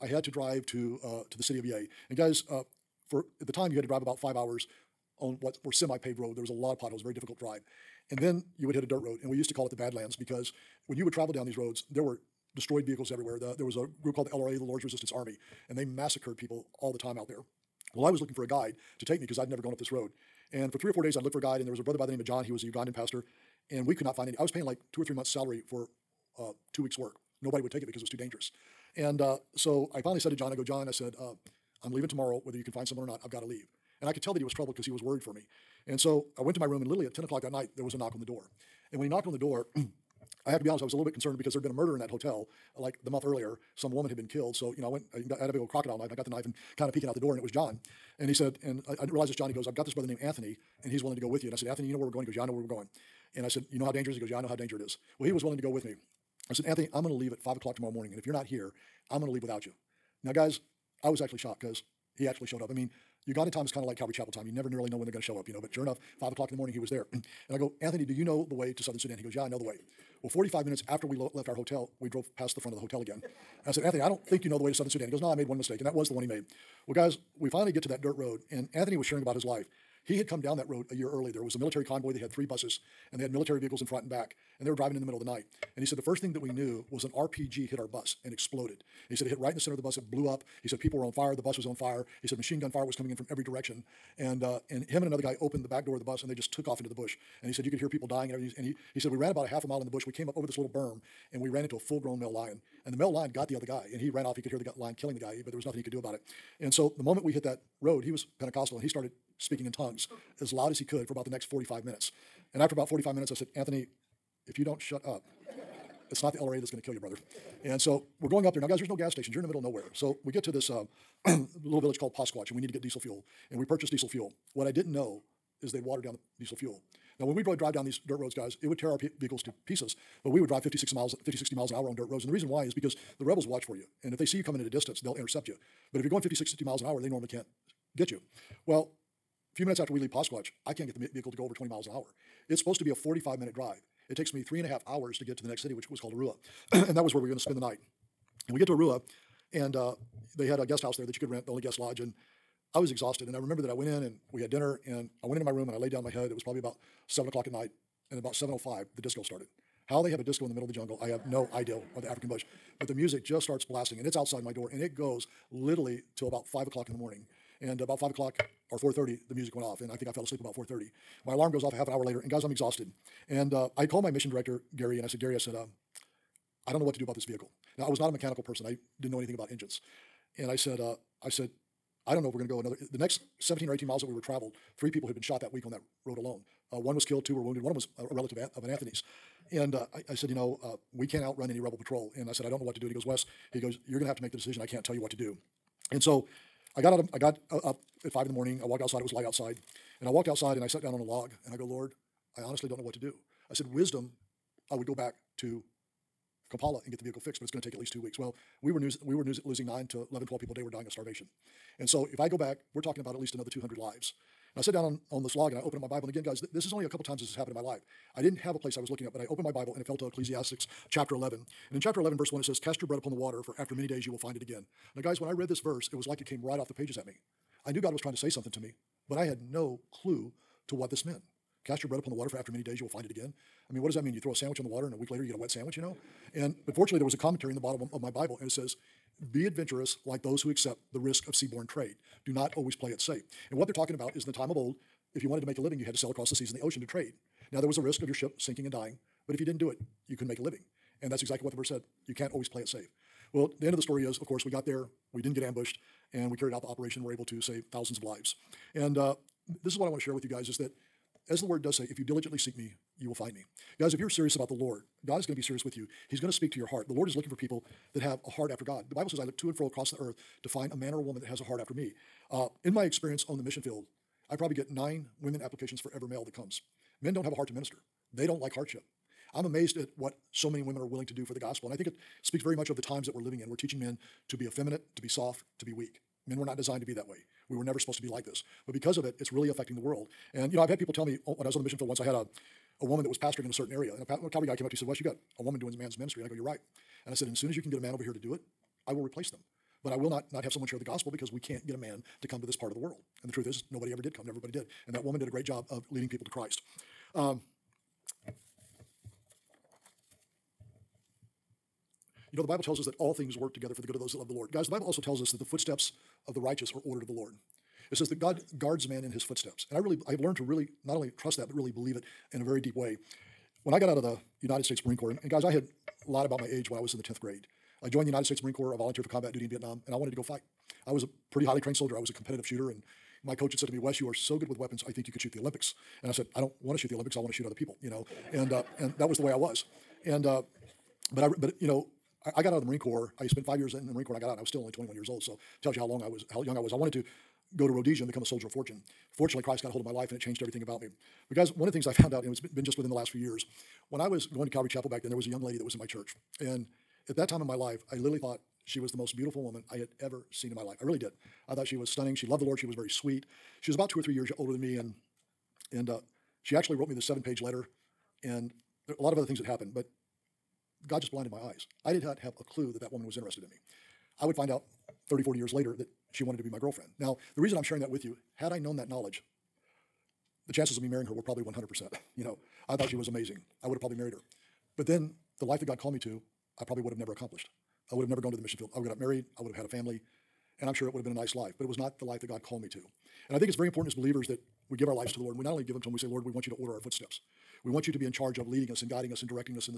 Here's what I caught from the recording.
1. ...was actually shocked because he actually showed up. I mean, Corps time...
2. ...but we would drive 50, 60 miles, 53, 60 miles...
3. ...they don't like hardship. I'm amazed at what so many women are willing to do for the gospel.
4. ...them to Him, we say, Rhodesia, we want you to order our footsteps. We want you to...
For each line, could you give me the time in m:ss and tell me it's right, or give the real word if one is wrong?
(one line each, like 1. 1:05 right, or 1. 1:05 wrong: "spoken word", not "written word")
1. 1:01 wrong: "Uganda", not "Corps"
2. 2:10 wrong: "50", not "53"
3. 4:38 right
4. 6:35 wrong: "Lord", not "Rhodesia".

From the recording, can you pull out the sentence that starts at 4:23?
Guys, if you're serious about the Lord, God is going to be serious with you.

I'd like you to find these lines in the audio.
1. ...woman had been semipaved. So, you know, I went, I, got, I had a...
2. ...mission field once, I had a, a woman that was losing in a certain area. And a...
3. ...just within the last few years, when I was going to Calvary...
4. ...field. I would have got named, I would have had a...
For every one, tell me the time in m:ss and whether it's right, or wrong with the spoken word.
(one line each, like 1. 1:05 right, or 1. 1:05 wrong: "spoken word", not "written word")
1. 0:43 wrong: "killed", not "semipaved"
2. 4:51 wrong: "pastoring", not "losing"
3. 5:52 right
4. 6:28 wrong: "married", not "named".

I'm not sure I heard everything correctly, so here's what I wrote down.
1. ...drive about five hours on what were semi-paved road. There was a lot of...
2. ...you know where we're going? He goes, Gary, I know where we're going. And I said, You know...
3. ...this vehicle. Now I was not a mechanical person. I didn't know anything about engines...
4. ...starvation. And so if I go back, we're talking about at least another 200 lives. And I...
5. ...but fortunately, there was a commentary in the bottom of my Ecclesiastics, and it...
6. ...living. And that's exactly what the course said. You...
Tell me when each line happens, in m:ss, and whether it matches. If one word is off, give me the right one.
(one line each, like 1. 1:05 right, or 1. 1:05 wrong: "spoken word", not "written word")
1. 0:03 right
2. 0:51 wrong: "Yeah", not "Gary"
3. 2:57 right
4. 3:30 right
5. 3:56 wrong: "Bible", not "Ecclesiastics"
6. 4:10 wrong: "verse", not "course".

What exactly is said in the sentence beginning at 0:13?
The, there was a group called the LRA, the Lord's Resistance Army, and they massacred people all the time out there.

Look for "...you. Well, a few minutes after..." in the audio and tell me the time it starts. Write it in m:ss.
2:18.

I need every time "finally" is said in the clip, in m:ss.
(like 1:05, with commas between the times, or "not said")
0:30, 1:17.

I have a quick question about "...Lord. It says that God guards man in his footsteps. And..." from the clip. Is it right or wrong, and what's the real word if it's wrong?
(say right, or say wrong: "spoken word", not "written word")
right.